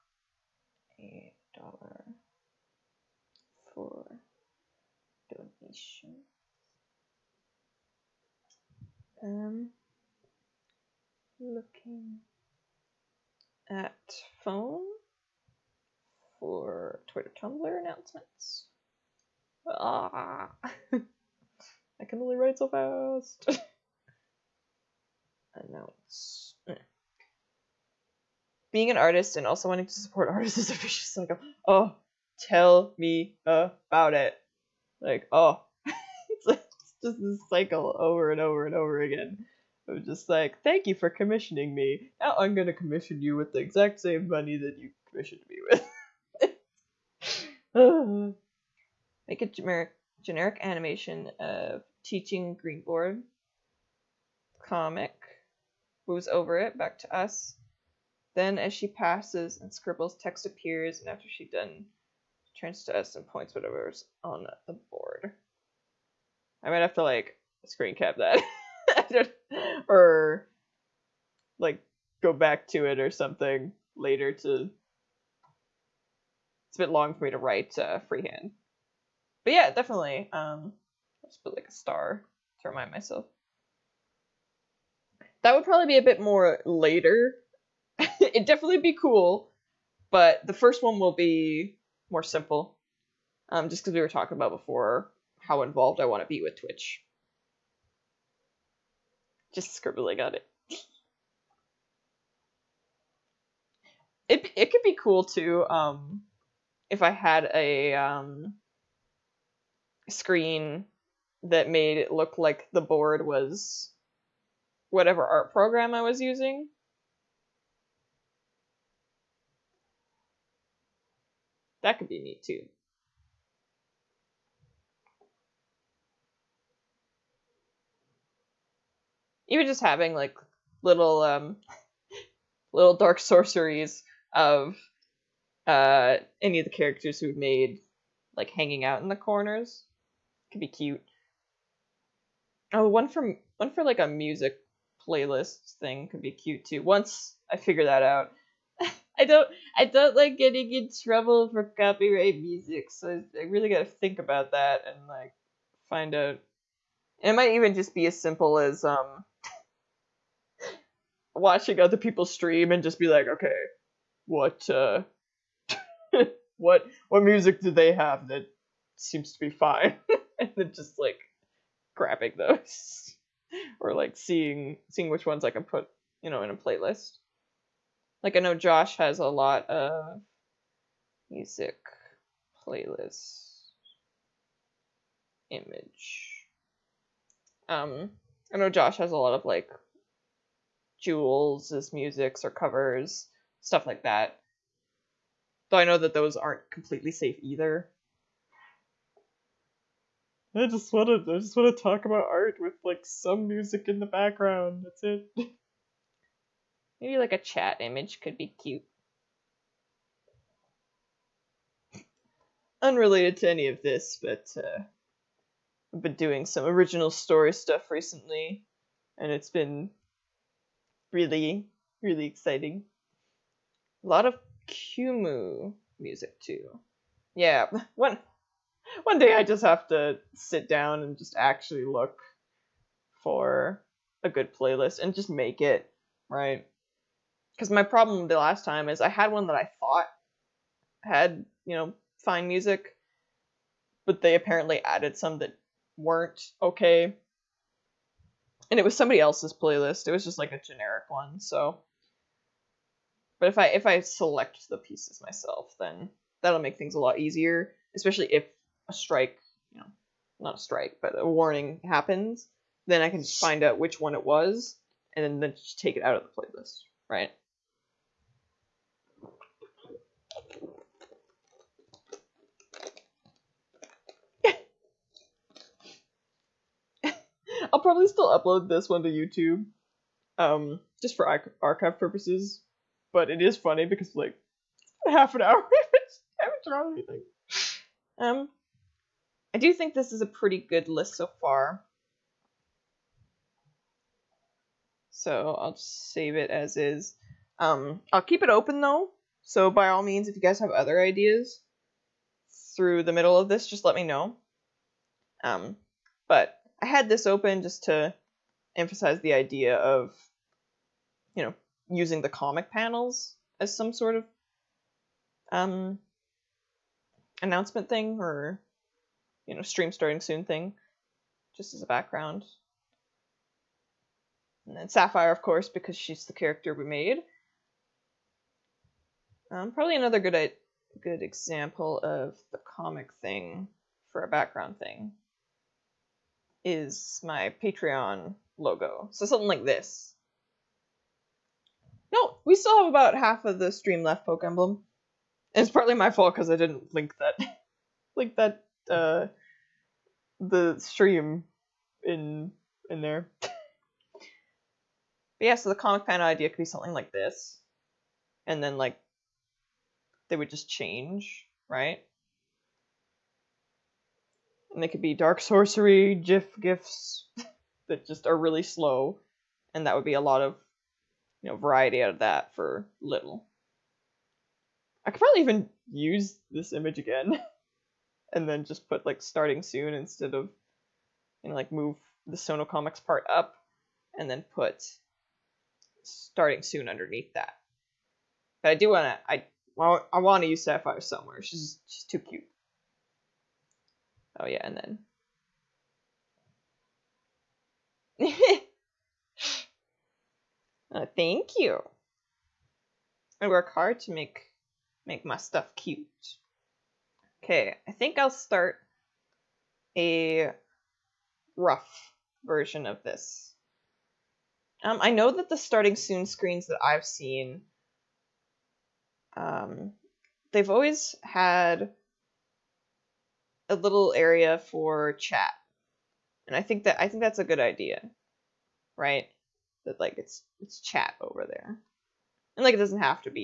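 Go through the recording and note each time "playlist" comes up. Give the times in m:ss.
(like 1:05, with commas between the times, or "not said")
2:25, 2:56, 3:02, 3:54, 4:09, 4:26.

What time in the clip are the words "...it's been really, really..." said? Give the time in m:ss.
3:39.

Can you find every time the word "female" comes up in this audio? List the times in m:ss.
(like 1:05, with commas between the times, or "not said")
not said.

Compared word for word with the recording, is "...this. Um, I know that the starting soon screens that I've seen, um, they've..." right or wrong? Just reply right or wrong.
right.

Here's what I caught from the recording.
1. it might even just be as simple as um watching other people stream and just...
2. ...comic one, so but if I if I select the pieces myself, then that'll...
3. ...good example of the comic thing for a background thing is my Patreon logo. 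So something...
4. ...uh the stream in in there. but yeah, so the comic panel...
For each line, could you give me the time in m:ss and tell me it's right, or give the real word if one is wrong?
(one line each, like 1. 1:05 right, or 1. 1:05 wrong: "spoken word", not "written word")
1. 2:37 right
2. 4:10 wrong: "generic", not "comic"
3. 5:31 right
4. 5:48 right.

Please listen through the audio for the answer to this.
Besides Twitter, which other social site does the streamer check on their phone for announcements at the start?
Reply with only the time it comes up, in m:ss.
0:17.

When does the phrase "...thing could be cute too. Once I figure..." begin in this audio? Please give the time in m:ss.
2:25.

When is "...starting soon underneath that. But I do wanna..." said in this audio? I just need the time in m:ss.
6:26.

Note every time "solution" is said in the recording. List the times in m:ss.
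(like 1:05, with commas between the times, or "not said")
not said.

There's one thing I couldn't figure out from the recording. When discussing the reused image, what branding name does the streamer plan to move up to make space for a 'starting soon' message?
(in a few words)
Sono Comics.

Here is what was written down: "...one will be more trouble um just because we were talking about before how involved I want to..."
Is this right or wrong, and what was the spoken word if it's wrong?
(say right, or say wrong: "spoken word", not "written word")
wrong: "simple", not "trouble".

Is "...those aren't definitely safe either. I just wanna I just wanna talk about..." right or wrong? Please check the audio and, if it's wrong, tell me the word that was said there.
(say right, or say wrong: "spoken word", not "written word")
wrong: "completely", not "definitely".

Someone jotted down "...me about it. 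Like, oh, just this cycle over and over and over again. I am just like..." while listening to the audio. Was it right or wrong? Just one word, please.
right.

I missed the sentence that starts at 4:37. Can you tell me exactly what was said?
I'll probably still upload this one to YouTube, um, just for archive purposes.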